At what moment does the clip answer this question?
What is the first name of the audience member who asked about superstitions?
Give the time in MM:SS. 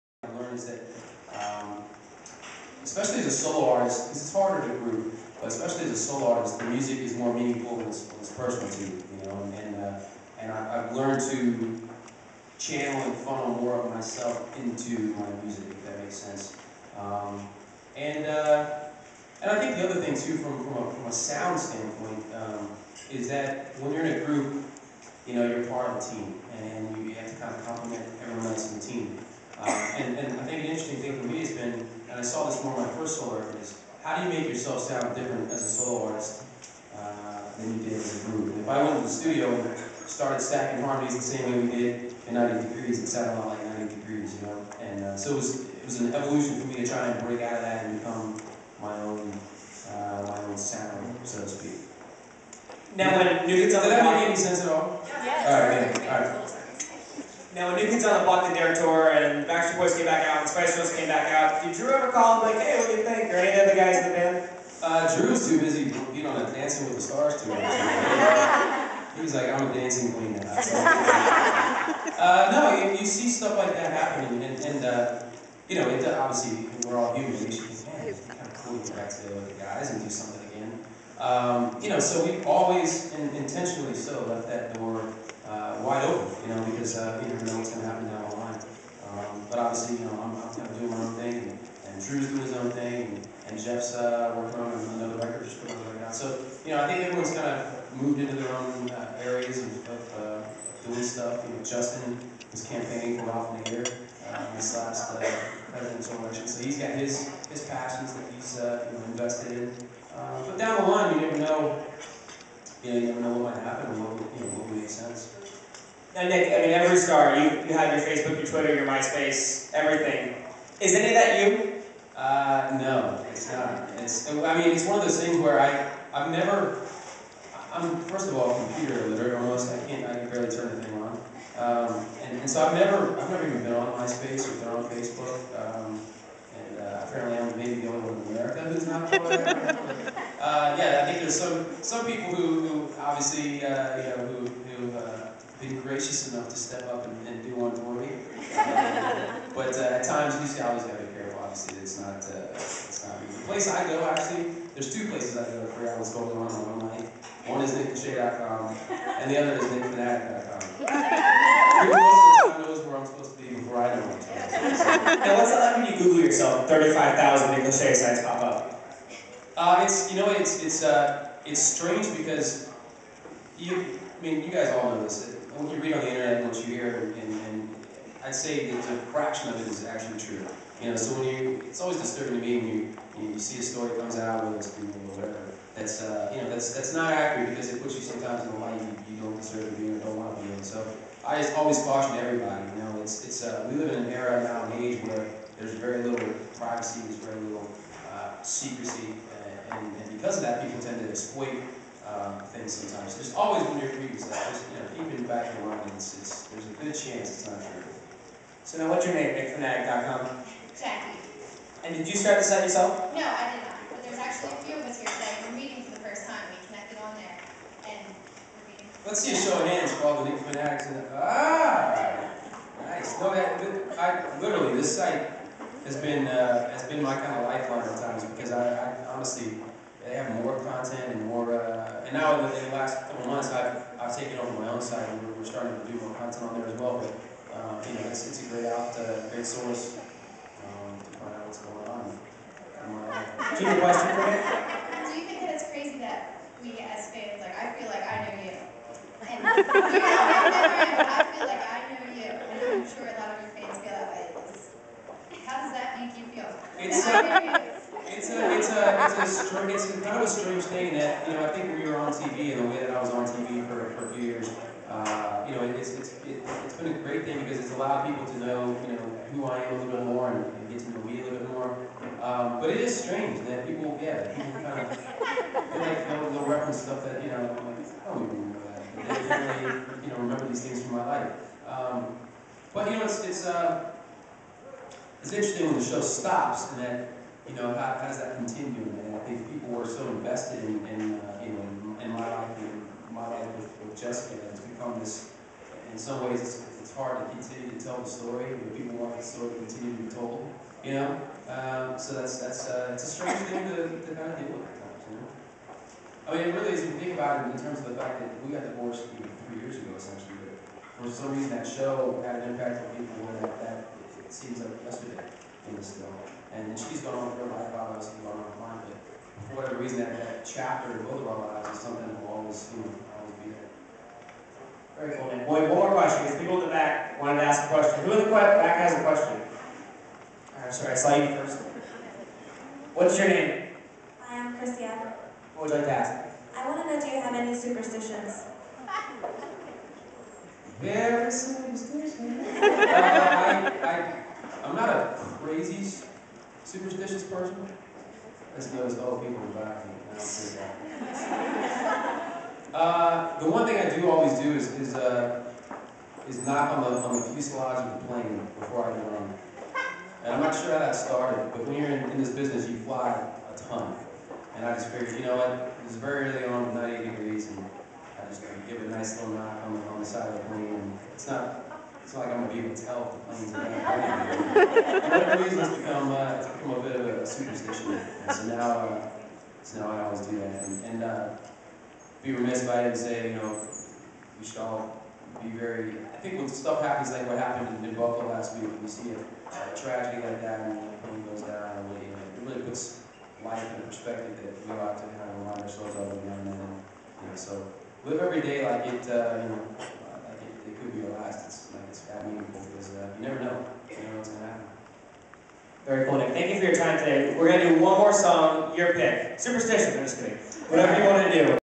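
05:34.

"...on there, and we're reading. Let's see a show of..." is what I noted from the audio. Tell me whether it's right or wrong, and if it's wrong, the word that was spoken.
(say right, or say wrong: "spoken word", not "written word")
wrong: "meeting", not "reading".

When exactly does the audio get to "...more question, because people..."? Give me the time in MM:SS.
05:25.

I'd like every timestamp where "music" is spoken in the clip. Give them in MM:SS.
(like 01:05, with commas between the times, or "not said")
00:06, 00:15.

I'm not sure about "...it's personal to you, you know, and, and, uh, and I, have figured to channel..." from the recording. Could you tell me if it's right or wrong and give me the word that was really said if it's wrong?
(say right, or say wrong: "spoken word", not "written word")
wrong: "learned", not "figured".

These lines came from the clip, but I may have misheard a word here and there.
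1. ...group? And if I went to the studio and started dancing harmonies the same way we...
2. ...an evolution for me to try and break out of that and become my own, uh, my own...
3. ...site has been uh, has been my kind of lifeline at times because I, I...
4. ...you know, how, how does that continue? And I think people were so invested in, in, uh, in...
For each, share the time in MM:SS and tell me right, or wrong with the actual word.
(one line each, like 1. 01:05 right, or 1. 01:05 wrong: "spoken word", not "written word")
1. 00:38 wrong: "stacking", not "dancing"
2. 00:46 right
3. 03:44 right
4. 04:47 right.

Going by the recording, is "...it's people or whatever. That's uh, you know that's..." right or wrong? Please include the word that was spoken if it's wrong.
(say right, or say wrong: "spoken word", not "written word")
right.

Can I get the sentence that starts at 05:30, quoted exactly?
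I'm sorry, I saw you first.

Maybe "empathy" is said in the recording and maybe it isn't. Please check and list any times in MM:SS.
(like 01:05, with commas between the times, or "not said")
not said.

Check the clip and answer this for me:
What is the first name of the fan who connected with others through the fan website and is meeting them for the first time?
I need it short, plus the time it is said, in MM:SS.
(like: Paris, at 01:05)
Jackie, at 03:30.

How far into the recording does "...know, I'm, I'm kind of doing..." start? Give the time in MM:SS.
01:30.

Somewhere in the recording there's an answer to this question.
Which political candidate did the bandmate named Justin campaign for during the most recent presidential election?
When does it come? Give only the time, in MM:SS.
01:43.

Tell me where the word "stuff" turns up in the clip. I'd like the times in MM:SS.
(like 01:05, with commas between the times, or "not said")
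01:13, 01:41, 03:24, 04:36, 06:26.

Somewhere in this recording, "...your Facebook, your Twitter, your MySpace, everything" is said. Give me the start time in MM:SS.
01:57.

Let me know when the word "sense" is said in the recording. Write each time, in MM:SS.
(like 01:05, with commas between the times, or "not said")
00:16, 00:54, 01:54.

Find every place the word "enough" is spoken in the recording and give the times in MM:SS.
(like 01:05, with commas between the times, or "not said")
02:26.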